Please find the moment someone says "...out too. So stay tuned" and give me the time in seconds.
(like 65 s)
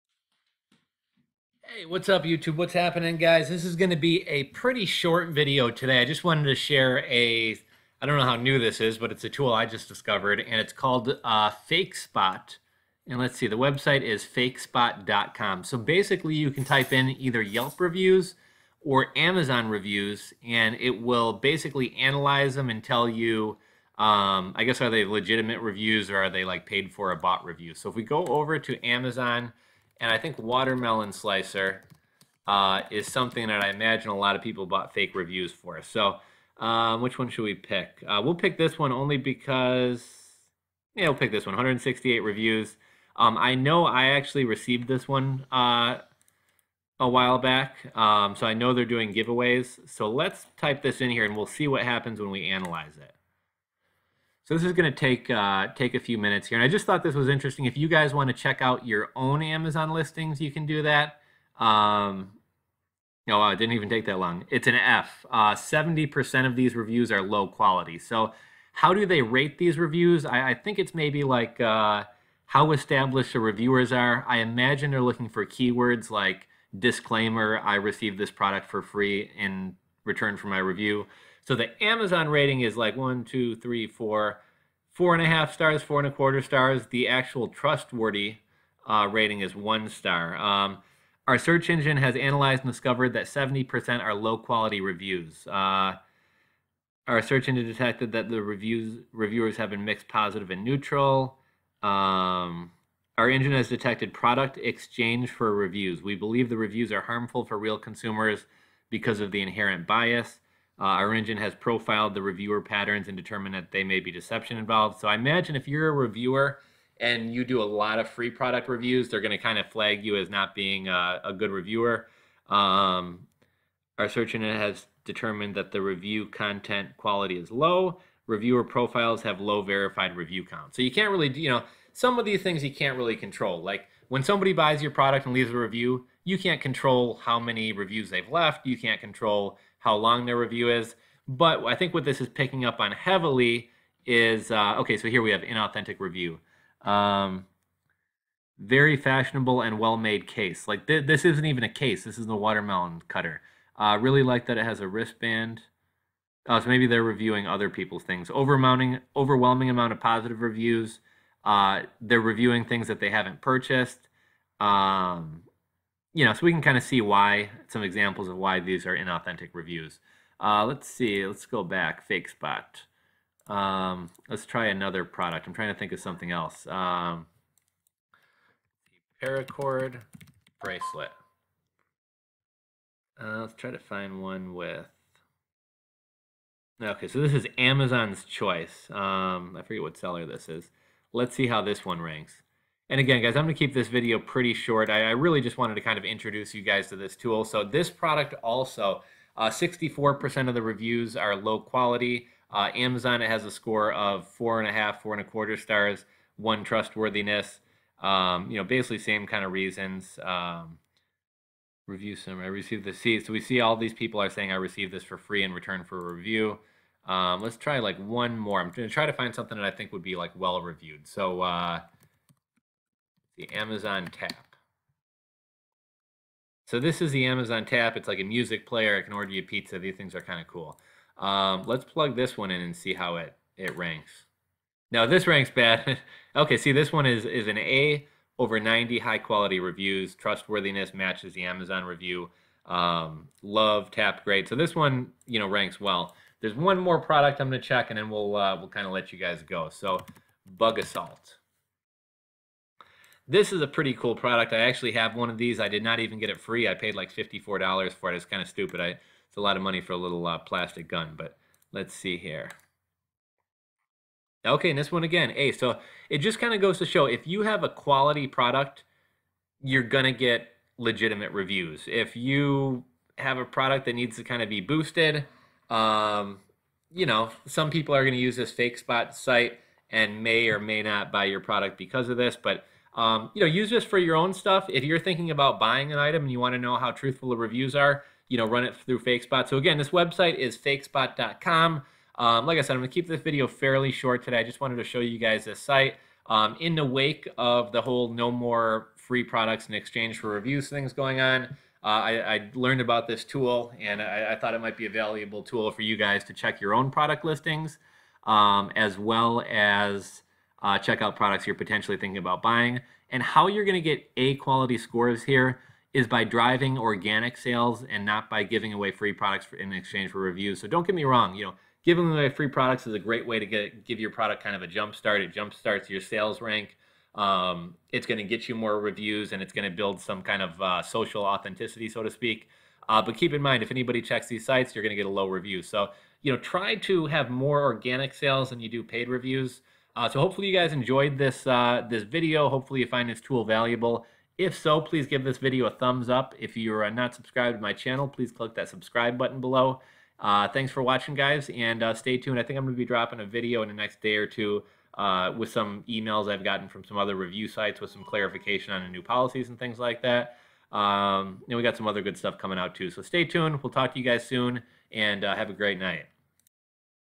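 362 s.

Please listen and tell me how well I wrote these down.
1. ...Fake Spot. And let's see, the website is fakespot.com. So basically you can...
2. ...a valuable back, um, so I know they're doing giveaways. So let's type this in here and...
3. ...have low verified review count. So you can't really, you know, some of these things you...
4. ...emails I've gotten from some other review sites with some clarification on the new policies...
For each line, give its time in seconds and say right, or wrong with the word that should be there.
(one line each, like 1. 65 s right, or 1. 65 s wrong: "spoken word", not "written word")
1. 11 s right
2. 46 s wrong: "while", not "valuable"
3. 129 s right
4. 355 s right.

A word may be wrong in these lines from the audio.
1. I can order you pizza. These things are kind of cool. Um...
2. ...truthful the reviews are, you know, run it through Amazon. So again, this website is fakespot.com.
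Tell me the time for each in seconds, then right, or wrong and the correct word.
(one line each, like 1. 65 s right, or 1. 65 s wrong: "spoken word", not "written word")
1. 228 s right
2. 286 s wrong: "FakeSpot", not "Amazon".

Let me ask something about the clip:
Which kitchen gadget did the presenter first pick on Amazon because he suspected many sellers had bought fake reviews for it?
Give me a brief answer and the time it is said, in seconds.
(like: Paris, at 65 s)
watermelon slicer, at 30 s.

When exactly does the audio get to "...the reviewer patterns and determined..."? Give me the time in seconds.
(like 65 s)
112 s.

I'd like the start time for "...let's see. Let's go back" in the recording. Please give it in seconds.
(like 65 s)
170 s.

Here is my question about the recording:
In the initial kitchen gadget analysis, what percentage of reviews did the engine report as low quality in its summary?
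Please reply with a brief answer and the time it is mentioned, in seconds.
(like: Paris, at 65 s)
70%, at 93 s.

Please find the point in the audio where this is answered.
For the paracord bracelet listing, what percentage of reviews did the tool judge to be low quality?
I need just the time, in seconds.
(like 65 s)
199 s.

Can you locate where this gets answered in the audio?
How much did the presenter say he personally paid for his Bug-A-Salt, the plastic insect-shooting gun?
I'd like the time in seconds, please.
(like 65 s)
257 s.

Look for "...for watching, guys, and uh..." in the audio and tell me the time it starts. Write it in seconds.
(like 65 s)
350 s.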